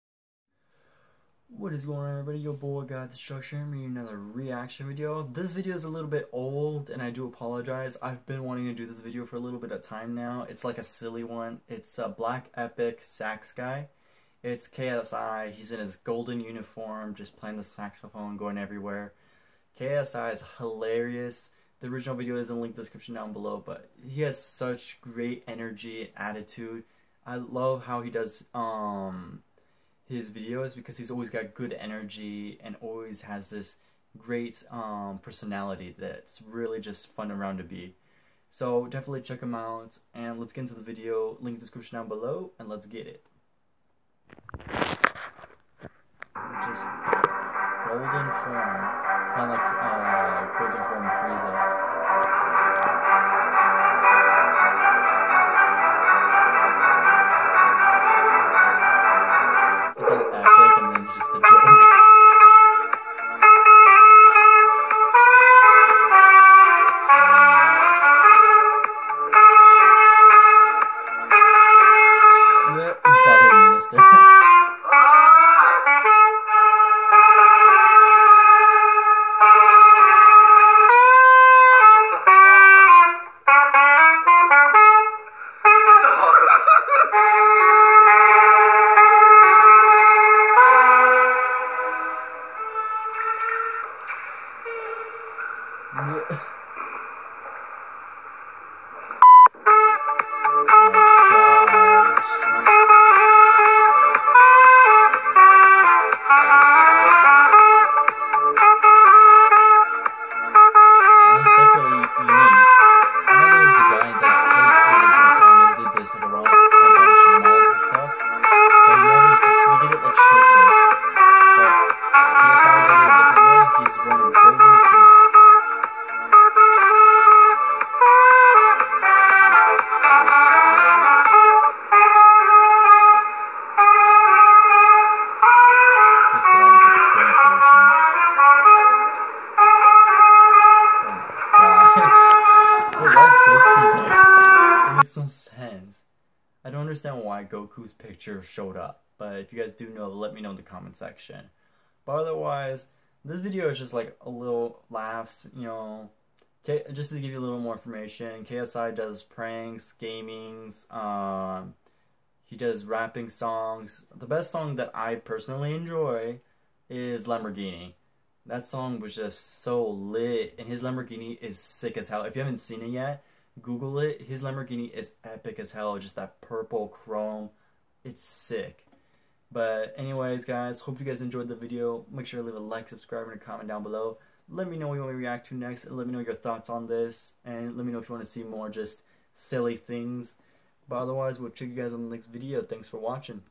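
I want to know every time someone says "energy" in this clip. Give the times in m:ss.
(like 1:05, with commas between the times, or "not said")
0:25, 0:31.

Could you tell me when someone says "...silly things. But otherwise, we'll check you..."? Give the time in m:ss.
3:09.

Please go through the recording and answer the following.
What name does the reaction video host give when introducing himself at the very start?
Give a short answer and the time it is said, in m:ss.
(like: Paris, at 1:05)
God Destruction, at 0:02.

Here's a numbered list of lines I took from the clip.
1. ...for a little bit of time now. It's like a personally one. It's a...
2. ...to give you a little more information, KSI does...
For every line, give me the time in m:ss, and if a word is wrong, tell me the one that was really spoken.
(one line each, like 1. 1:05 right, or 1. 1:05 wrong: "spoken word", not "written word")
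1. 0:09 wrong: "silly", not "personally"
2. 2:37 right.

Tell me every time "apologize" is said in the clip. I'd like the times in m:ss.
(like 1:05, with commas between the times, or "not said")
0:07.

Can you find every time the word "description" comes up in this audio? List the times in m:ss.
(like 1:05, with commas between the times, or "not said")
0:22, 0:41.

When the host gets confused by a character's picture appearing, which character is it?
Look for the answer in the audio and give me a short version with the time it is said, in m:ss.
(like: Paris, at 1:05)
Goku, at 2:27.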